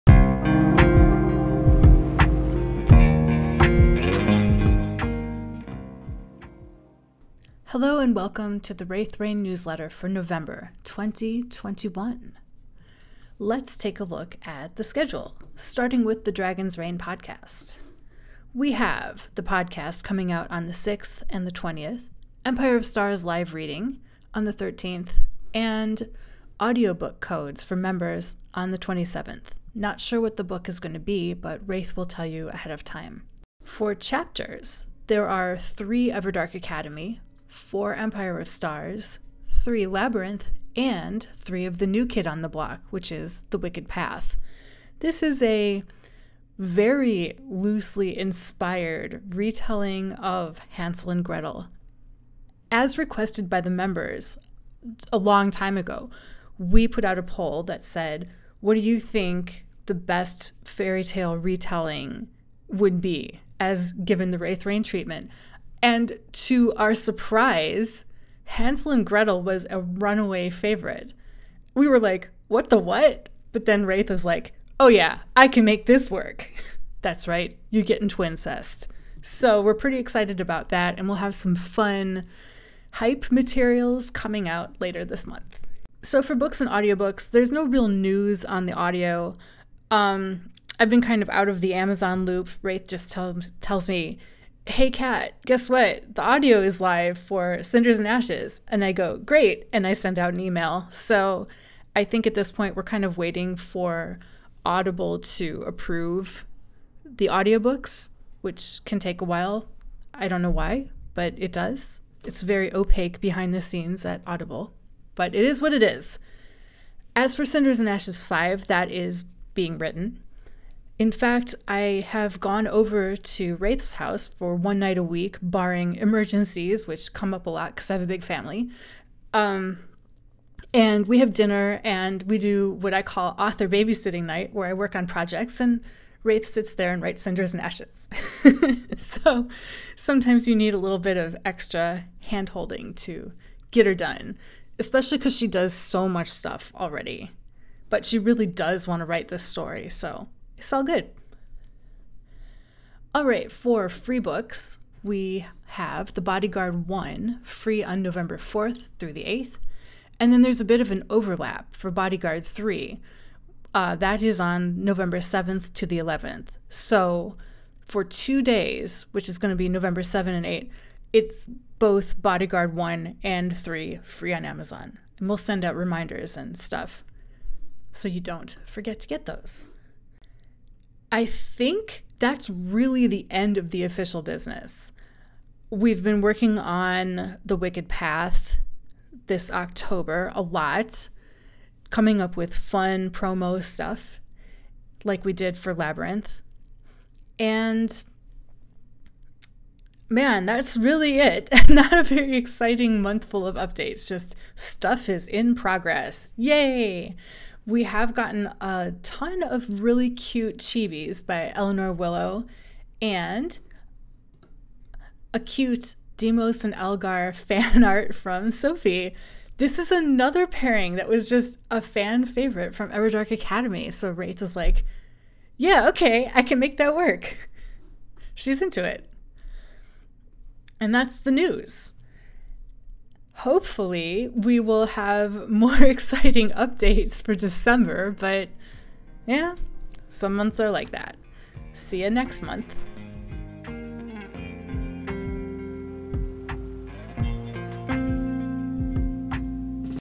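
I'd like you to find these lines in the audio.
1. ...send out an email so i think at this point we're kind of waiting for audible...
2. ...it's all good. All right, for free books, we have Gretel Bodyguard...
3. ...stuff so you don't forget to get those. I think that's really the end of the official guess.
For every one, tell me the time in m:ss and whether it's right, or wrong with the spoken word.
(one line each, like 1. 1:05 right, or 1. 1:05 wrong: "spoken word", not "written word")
1. 1:39 right
2. 2:30 wrong: "The", not "Gretel"
3. 2:56 wrong: "business", not "guess".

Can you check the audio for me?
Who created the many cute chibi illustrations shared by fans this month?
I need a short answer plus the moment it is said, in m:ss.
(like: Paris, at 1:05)
Eleanor Willow, at 3:31.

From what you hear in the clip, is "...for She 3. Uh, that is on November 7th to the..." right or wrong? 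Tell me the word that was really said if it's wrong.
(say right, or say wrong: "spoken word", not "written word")
wrong: "Bodyguard", not "She".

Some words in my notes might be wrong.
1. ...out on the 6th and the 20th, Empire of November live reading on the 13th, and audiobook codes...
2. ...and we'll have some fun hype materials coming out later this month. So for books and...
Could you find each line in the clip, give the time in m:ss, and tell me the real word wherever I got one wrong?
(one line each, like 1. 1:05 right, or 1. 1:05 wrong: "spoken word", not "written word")
1. 0:20 wrong: "Stars", not "November"
2. 1:20 right.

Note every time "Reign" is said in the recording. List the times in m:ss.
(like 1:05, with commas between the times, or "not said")
0:09, 0:16, 1:04.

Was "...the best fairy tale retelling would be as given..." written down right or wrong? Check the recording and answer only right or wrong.
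right.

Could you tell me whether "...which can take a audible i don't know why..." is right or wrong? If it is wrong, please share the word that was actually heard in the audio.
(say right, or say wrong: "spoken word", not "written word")
wrong: "while", not "audible".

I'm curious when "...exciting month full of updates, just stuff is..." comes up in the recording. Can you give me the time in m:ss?
3:22.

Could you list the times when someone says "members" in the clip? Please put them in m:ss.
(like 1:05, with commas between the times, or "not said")
0:27, 0:53.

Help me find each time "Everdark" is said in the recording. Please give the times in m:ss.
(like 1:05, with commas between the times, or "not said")
0:36, 3:42.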